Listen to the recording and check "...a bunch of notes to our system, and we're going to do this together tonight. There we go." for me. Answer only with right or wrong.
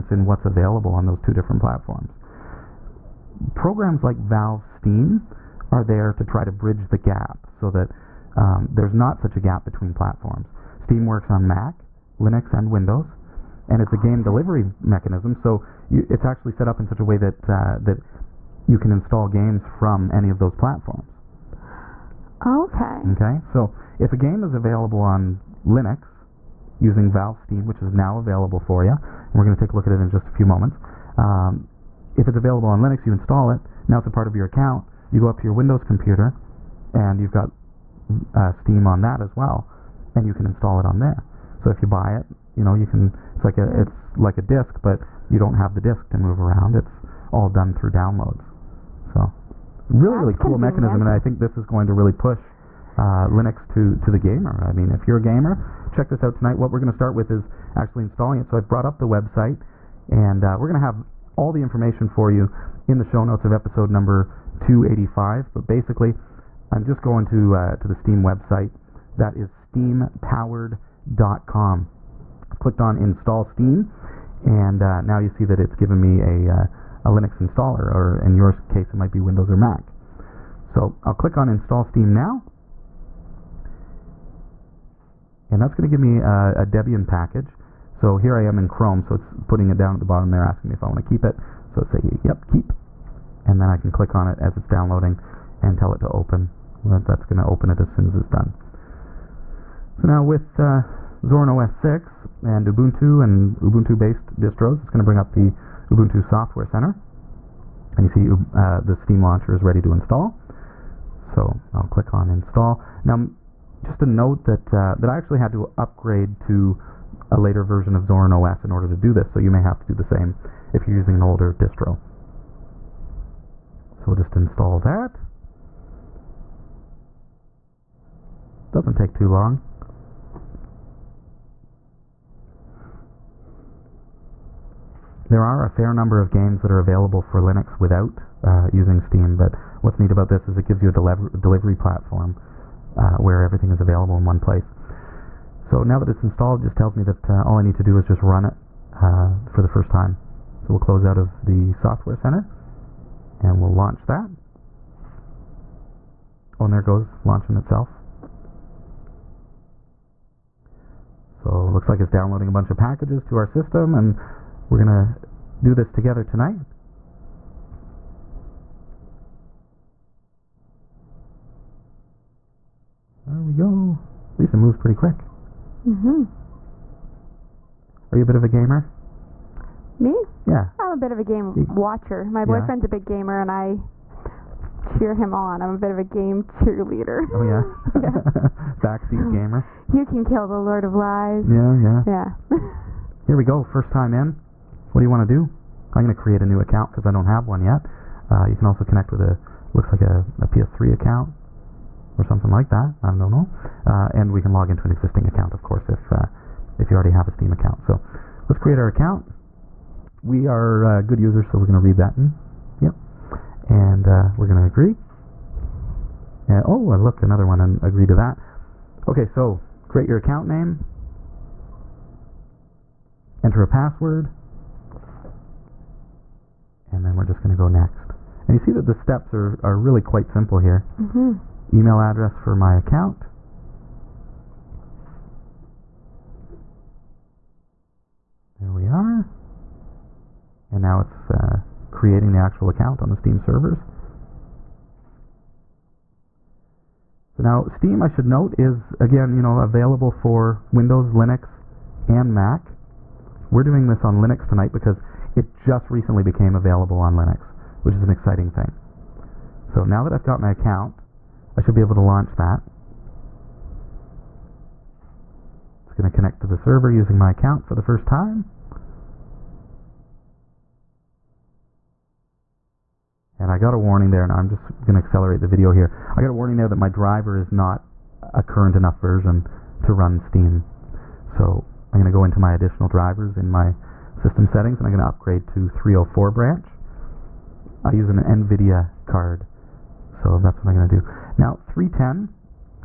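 wrong.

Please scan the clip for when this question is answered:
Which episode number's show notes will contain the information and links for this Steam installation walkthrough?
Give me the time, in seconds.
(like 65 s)
64 s.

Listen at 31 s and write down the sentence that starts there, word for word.
Um, if it's available on Linux, you install it.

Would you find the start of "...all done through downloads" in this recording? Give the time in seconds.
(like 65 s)
47 s.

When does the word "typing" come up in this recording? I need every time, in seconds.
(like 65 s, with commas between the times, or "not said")
not said.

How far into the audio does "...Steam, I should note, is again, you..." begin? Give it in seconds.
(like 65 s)
247 s.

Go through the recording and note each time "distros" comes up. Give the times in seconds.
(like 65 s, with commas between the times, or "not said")
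104 s, 121 s.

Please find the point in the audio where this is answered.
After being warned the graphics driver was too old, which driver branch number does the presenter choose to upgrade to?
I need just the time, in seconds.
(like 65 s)
285 s.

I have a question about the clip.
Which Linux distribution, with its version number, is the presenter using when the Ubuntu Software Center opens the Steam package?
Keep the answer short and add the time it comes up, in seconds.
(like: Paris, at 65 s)
Zorin OS 6, at 101 s.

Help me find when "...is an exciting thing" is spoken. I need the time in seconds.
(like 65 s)
257 s.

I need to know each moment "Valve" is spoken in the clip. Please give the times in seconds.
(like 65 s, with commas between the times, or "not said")
4 s, 27 s.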